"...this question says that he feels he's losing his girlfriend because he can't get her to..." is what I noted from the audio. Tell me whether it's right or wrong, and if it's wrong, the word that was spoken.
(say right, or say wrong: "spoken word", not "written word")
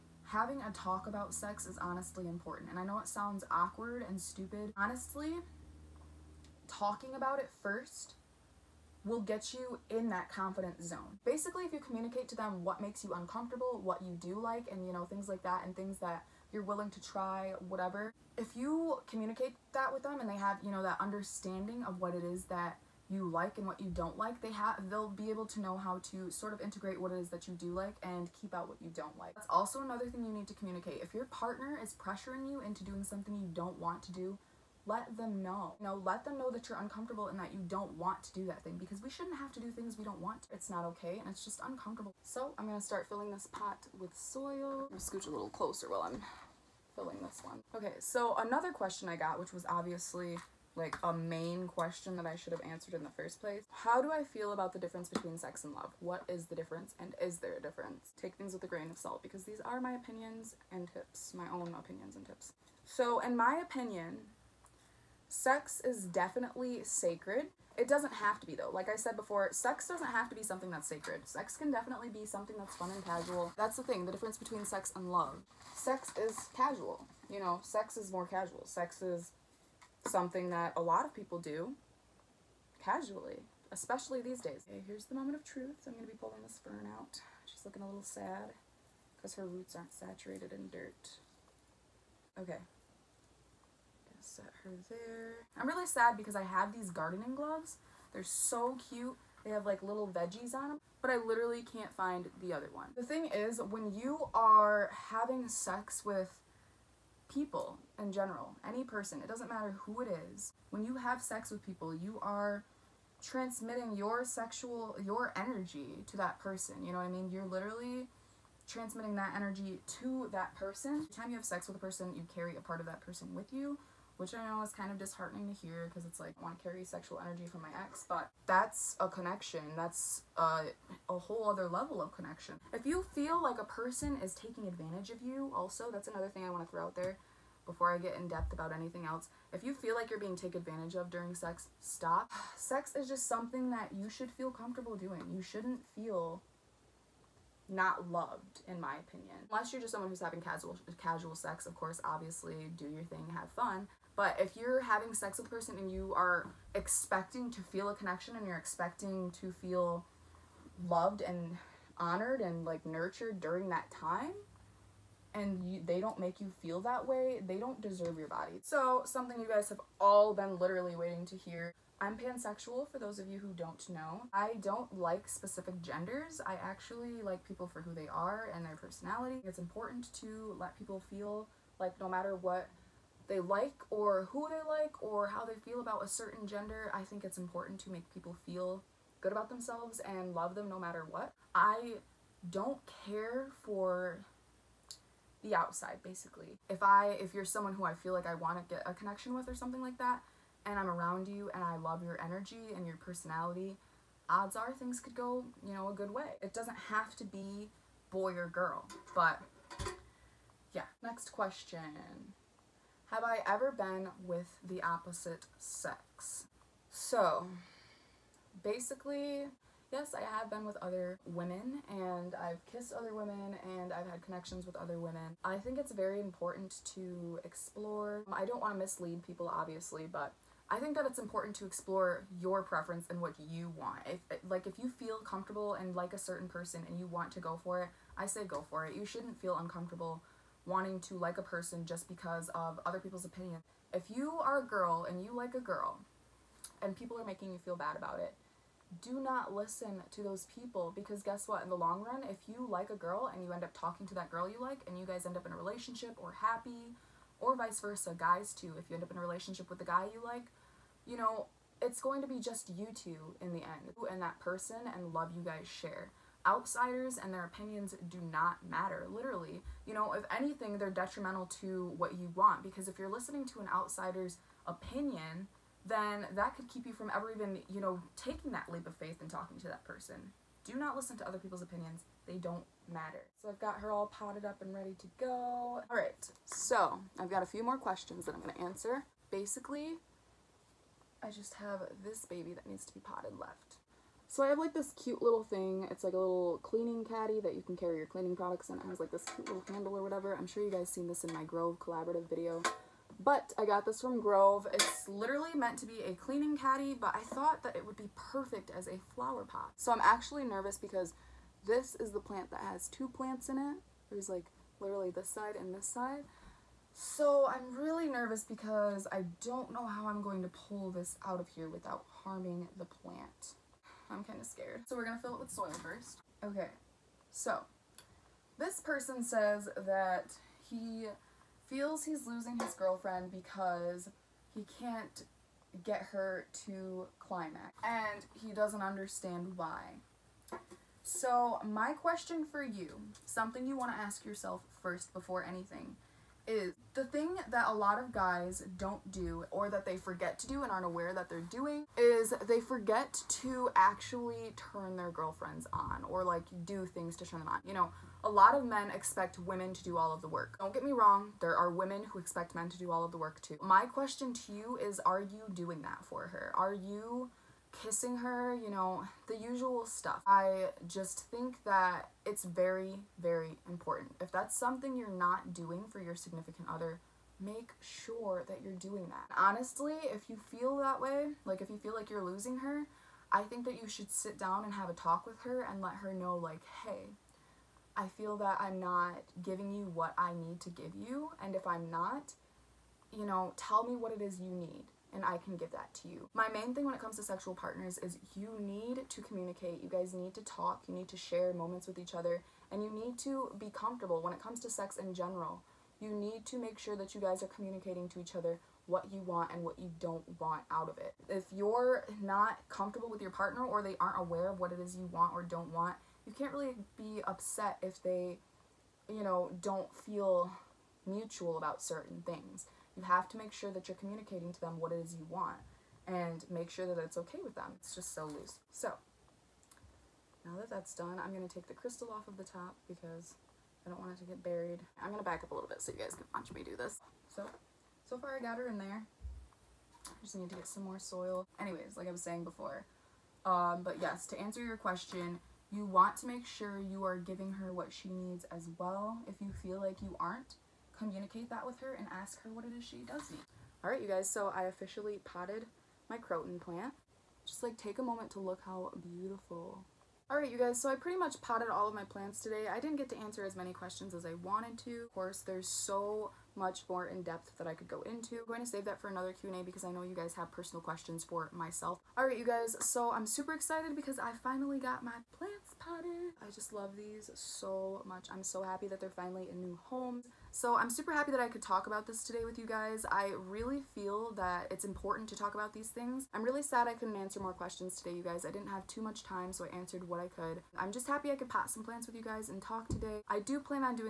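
wrong: "person", not "question".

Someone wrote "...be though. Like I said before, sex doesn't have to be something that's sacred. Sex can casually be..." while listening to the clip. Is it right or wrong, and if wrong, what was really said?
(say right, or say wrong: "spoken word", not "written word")
wrong: "definitely", not "casually".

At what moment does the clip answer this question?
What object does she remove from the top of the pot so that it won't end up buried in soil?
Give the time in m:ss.
7:11.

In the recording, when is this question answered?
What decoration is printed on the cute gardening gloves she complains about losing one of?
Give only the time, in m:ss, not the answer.
1:39.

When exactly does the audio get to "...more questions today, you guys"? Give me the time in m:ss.
8:07.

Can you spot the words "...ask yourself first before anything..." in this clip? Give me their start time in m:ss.
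5:44.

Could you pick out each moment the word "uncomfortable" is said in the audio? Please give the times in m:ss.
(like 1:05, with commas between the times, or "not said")
0:13, 0:36, 0:41, 3:59.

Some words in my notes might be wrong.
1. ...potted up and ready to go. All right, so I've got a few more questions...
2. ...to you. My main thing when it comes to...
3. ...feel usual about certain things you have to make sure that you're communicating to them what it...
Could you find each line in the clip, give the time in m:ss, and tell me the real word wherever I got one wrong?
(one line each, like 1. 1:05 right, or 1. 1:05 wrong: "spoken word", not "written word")
1. 4:44 right
2. 6:36 right
3. 6:59 wrong: "mutual", not "usual".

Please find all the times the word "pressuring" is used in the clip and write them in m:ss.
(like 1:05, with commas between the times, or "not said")
0:31.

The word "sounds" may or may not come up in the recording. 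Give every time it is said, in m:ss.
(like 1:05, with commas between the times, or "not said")
0:03.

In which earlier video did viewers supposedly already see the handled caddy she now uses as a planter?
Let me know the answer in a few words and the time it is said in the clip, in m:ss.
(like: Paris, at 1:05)
Grove Collaborative, at 5:01.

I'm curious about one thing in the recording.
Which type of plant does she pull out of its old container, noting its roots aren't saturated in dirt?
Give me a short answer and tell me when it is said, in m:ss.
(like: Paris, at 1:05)
fern, at 1:26.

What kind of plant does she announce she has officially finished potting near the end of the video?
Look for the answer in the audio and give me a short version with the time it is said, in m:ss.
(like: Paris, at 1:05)
croton, at 7:36.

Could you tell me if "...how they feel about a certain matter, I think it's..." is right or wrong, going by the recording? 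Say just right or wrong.
wrong.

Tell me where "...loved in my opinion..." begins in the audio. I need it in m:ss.
2:28.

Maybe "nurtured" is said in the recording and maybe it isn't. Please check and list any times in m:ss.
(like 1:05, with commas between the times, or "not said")
2:42.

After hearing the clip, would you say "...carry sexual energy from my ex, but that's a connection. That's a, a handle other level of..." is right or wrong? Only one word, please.
wrong.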